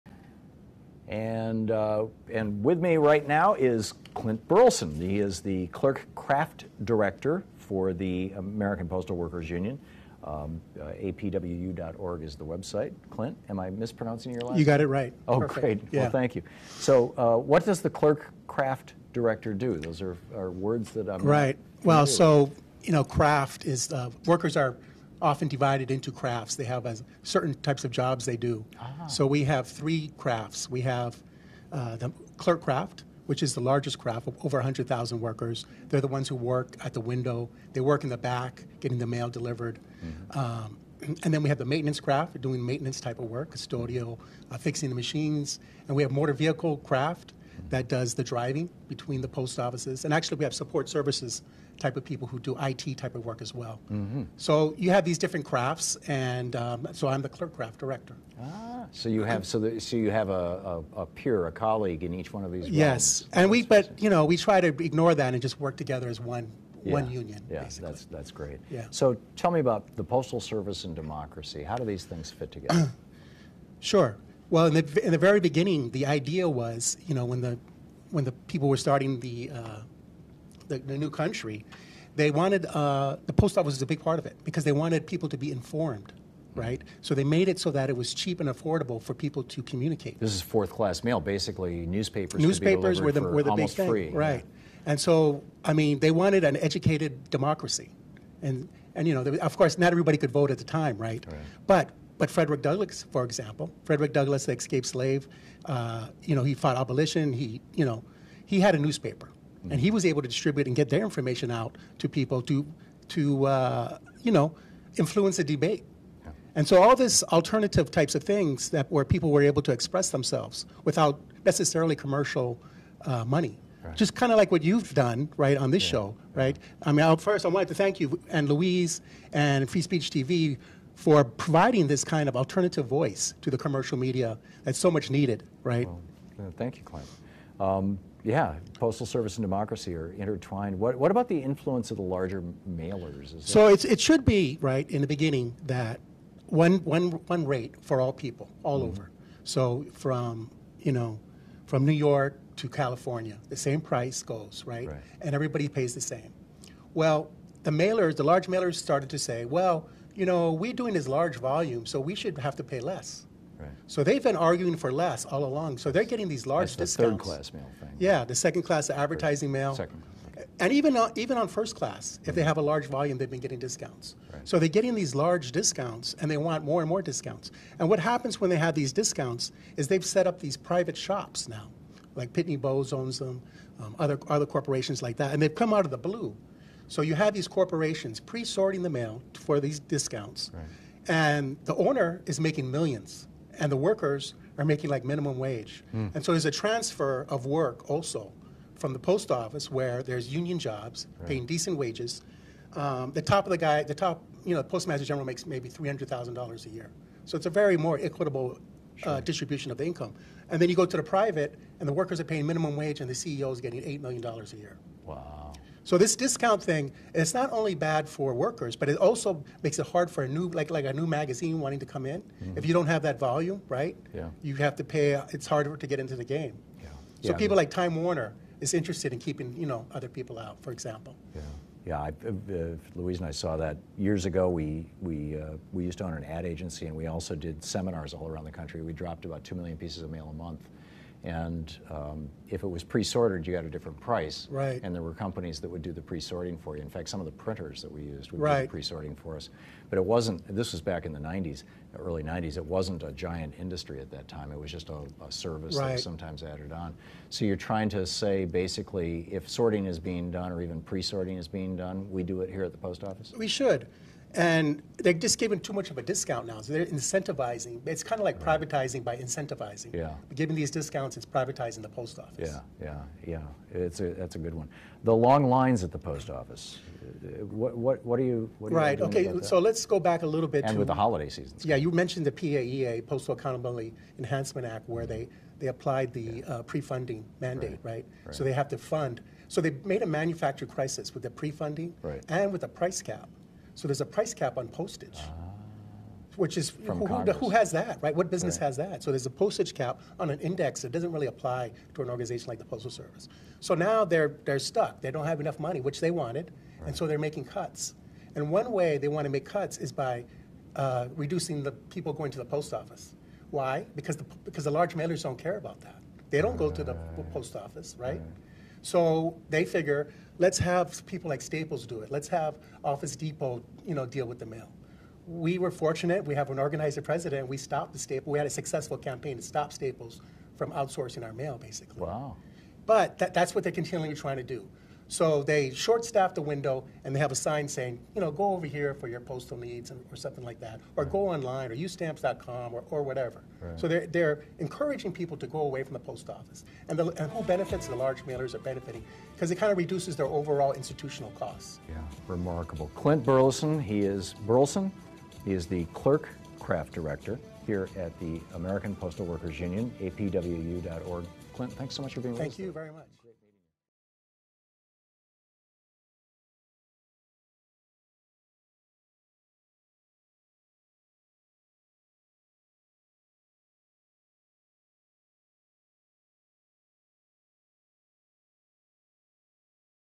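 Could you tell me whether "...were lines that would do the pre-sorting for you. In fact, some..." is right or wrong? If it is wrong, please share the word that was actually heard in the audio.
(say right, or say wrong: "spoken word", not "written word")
wrong: "companies", not "lines".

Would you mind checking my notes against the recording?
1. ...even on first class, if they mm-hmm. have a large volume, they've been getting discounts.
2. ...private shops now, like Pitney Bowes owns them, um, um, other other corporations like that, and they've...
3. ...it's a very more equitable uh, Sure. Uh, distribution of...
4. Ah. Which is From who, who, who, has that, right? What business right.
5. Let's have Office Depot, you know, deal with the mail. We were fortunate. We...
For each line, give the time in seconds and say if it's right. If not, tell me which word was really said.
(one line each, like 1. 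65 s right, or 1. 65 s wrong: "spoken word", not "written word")
1. 171 s right
2. 180 s right
3. 207 s right
4. 295 s right
5. 322 s right.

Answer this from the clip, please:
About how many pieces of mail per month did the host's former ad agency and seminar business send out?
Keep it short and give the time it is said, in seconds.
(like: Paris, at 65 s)
2 million, at 239 s.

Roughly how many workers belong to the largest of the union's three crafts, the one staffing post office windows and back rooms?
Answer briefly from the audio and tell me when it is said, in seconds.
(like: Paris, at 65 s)
over 100,000, at 34 s.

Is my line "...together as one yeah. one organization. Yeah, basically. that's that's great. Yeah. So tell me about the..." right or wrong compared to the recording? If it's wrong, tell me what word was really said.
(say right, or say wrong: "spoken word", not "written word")
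wrong: "union", not "organization".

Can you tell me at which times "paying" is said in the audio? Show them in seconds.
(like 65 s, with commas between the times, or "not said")
201 s, 212 s.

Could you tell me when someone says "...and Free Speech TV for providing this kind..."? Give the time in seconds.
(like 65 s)
129 s.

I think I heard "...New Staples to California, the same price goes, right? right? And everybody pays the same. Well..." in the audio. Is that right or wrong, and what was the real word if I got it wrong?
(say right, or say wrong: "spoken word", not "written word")
wrong: "York", not "Staples".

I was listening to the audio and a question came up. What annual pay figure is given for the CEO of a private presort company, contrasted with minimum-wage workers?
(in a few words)
$8 million.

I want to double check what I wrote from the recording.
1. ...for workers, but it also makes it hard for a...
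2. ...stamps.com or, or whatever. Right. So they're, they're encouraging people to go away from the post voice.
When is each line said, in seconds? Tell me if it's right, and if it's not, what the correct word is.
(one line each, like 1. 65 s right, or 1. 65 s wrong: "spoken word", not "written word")
1. 218 s right
2. 341 s wrong: "office", not "voice".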